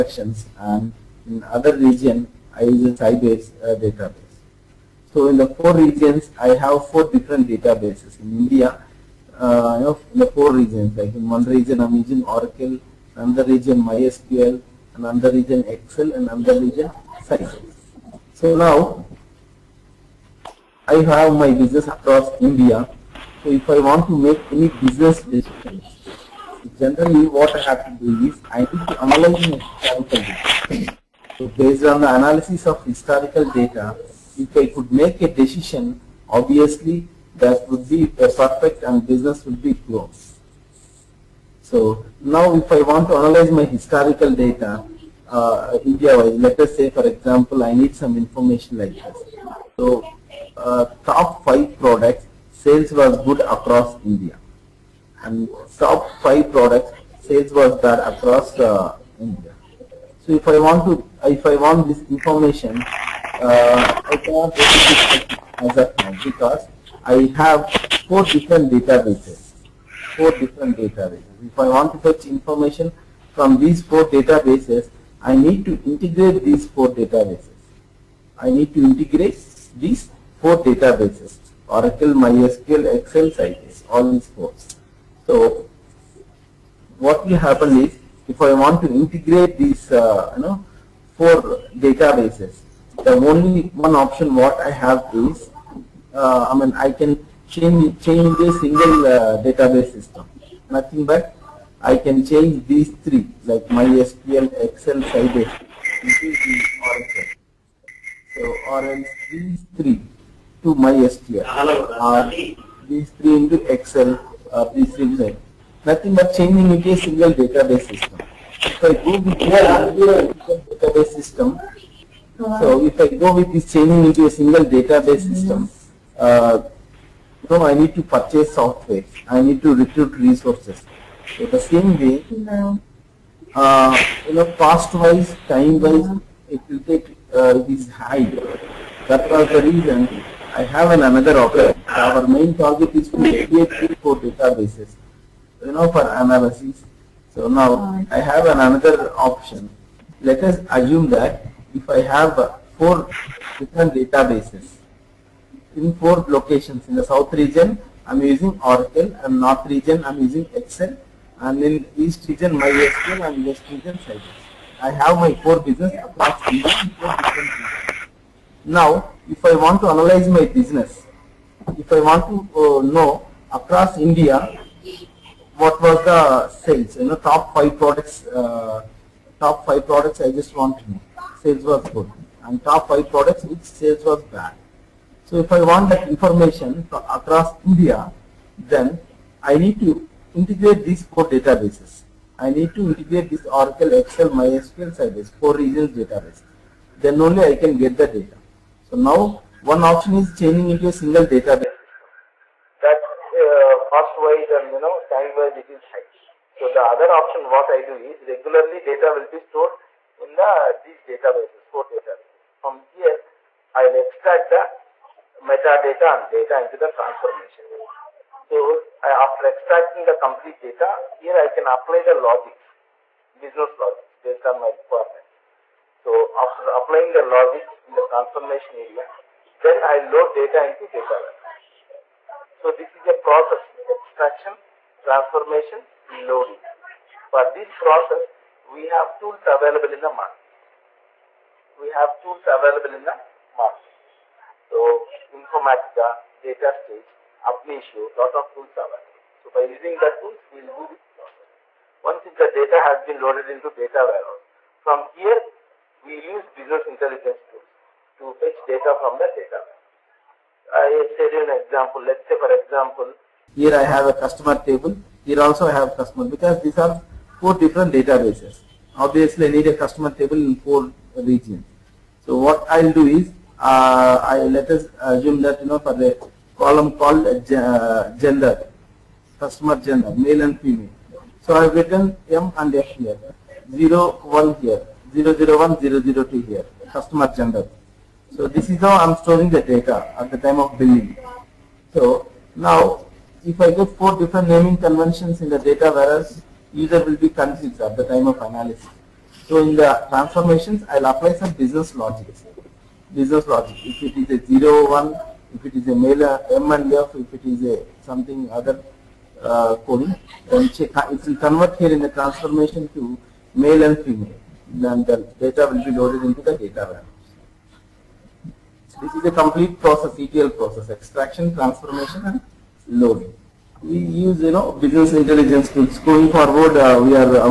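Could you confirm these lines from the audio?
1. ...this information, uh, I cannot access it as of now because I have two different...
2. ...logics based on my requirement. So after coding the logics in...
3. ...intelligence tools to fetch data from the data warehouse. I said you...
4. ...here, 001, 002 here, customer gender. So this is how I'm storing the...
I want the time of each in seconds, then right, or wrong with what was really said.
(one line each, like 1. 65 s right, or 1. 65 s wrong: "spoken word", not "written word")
1. 61 s wrong: "four", not "two"
2. 223 s wrong: "applying", not "coding"
3. 256 s right
4. 284 s right.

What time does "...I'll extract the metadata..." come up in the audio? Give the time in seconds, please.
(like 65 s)
213 s.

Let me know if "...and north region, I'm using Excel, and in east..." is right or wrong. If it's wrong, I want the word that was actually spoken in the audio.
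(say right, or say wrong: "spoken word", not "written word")
right.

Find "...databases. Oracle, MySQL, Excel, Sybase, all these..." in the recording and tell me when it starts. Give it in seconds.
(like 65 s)
80 s.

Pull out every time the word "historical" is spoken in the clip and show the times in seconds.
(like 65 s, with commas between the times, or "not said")
32 s, 43 s.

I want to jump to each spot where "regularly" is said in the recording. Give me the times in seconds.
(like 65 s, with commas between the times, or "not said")
208 s.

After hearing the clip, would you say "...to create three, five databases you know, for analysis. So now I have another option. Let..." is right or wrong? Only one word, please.
wrong.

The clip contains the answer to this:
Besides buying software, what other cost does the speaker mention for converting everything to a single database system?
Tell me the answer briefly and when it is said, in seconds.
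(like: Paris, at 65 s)
Recruit resources, at 129 s.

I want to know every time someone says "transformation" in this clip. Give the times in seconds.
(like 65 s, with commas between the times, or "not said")
216 s, 228 s, 235 s, 300 s, 312 s, 321 s.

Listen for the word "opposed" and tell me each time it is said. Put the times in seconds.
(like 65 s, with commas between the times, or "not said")
not said.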